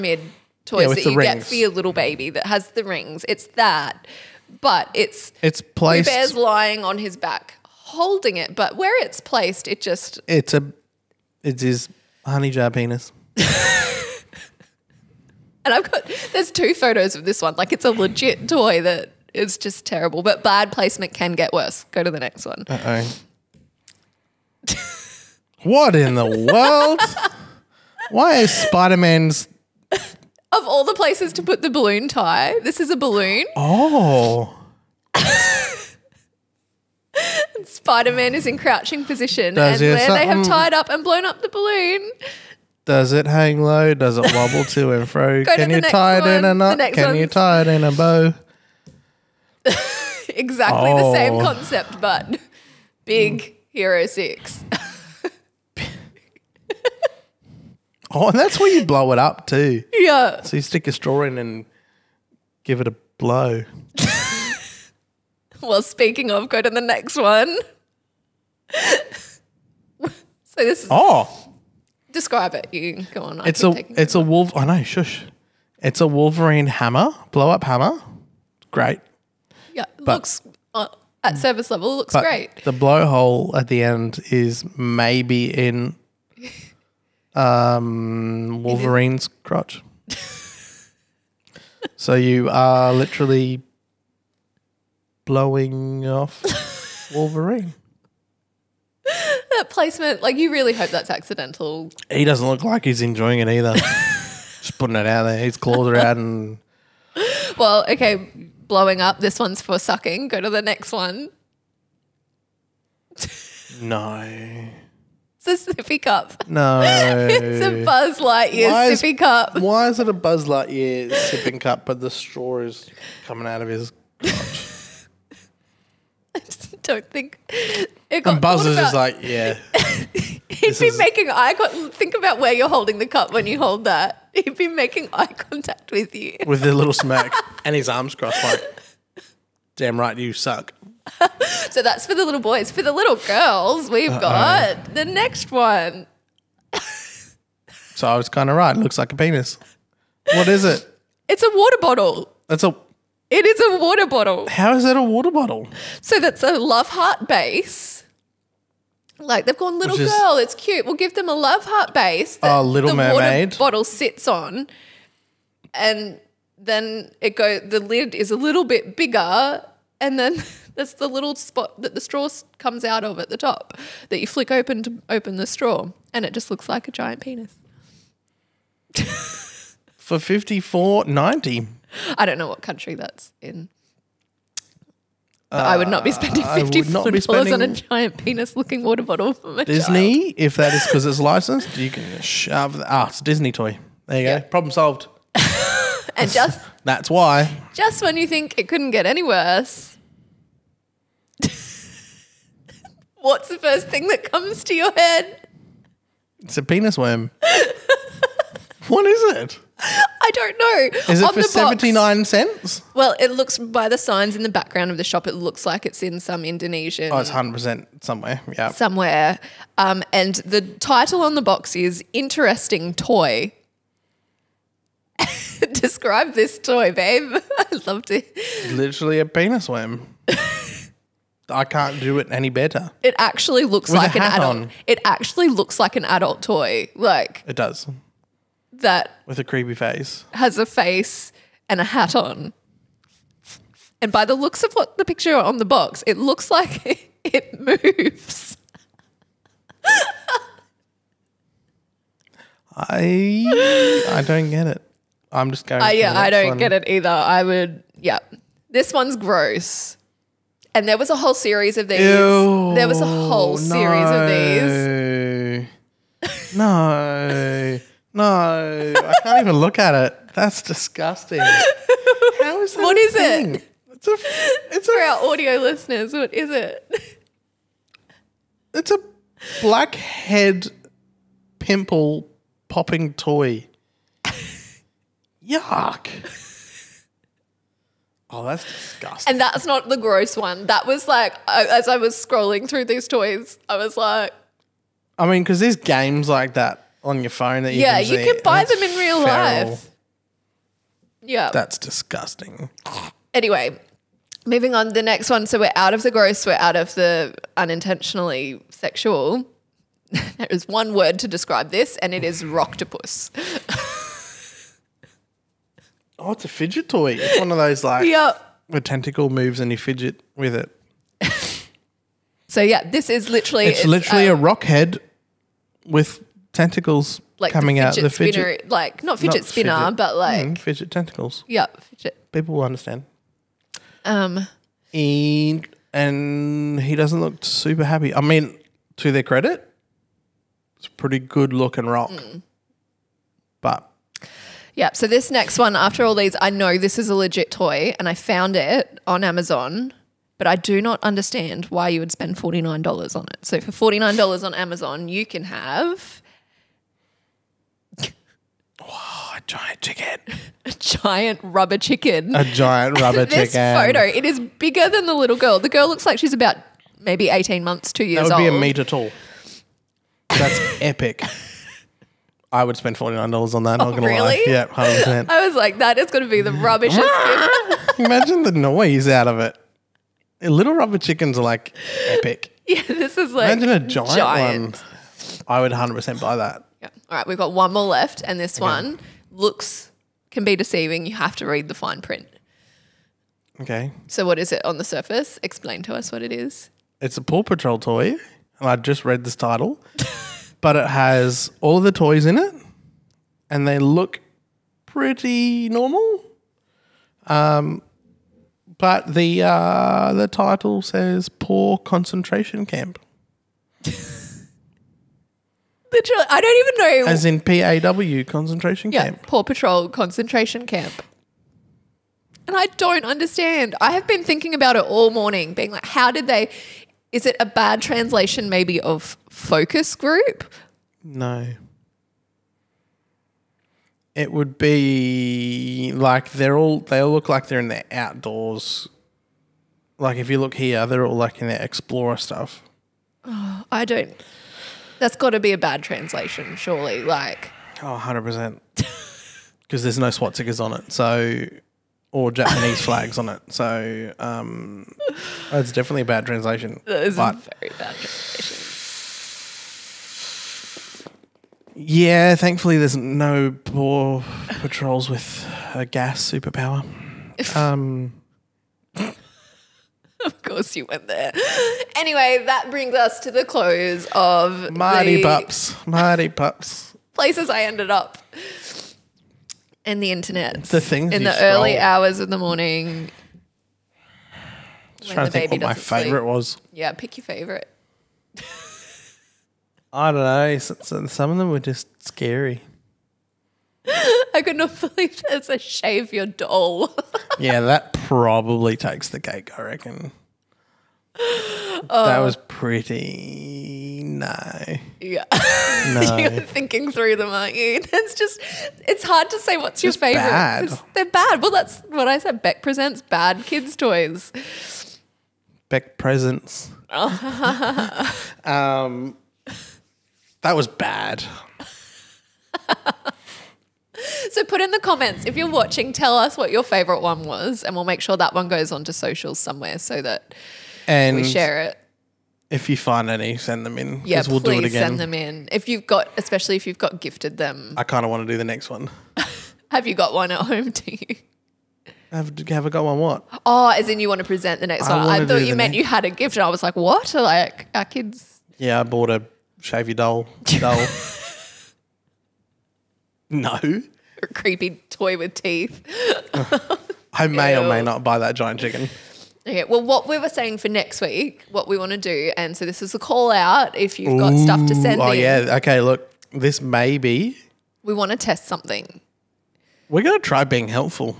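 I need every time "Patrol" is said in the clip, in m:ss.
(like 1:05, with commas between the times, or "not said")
6:37, 6:59, 7:44.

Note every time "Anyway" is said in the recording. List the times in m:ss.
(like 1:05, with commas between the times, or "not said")
5:03, 7:51.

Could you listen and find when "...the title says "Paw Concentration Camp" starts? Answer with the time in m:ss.
6:50.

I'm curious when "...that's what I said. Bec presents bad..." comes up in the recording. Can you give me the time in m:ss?
8:31.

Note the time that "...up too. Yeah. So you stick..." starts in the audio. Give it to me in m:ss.
0:59.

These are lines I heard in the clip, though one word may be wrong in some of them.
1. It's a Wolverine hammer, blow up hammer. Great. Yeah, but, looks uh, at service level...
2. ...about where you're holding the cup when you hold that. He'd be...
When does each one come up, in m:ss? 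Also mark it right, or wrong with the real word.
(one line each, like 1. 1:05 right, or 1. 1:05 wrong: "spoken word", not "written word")
1. 1:15 right
2. 2:12 right.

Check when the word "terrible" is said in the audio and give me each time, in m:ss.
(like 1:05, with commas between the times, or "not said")
0:19.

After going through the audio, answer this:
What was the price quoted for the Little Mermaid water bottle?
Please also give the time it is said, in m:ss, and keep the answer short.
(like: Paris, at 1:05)
54.90, at 3:00.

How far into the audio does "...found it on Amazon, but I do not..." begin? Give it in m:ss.
5:48.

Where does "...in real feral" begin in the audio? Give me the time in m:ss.
4:58.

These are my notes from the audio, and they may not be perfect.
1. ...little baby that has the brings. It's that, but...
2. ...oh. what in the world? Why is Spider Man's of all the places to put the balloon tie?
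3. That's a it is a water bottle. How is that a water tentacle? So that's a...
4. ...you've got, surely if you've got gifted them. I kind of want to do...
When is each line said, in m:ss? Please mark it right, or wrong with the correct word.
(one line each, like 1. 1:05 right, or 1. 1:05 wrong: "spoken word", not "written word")
1. 0:01 wrong: "rings", not "brings"
2. 0:23 right
3. 2:32 wrong: "bottle", not "tentacle"
4. 8:55 wrong: "especially", not "surely".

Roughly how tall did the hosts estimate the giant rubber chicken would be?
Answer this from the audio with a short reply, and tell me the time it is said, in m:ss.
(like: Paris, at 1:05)
a metre, at 6:08.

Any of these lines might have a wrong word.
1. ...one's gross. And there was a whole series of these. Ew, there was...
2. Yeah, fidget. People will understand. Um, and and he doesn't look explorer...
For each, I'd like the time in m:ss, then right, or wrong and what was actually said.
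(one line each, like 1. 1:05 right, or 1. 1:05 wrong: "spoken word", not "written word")
1. 4:18 right
2. 5:31 wrong: "super", not "explorer".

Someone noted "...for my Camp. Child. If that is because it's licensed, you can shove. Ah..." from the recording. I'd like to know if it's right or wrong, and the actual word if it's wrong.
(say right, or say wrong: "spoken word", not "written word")
wrong: "Disney", not "Camp".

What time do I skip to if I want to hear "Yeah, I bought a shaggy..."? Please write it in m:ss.
9:08.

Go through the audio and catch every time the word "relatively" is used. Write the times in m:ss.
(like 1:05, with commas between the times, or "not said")
not said.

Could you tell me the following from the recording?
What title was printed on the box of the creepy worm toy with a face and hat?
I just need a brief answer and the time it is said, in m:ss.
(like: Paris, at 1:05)
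Interesting Toy, at 3:42.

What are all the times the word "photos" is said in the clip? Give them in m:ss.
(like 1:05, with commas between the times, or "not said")
0:16, 6:03.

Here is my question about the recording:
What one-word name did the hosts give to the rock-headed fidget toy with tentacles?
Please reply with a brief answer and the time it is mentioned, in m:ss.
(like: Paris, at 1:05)
rocktopus, at 5:12.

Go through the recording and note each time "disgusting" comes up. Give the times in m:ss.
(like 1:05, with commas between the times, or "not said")
4:30, 4:48, 5:01.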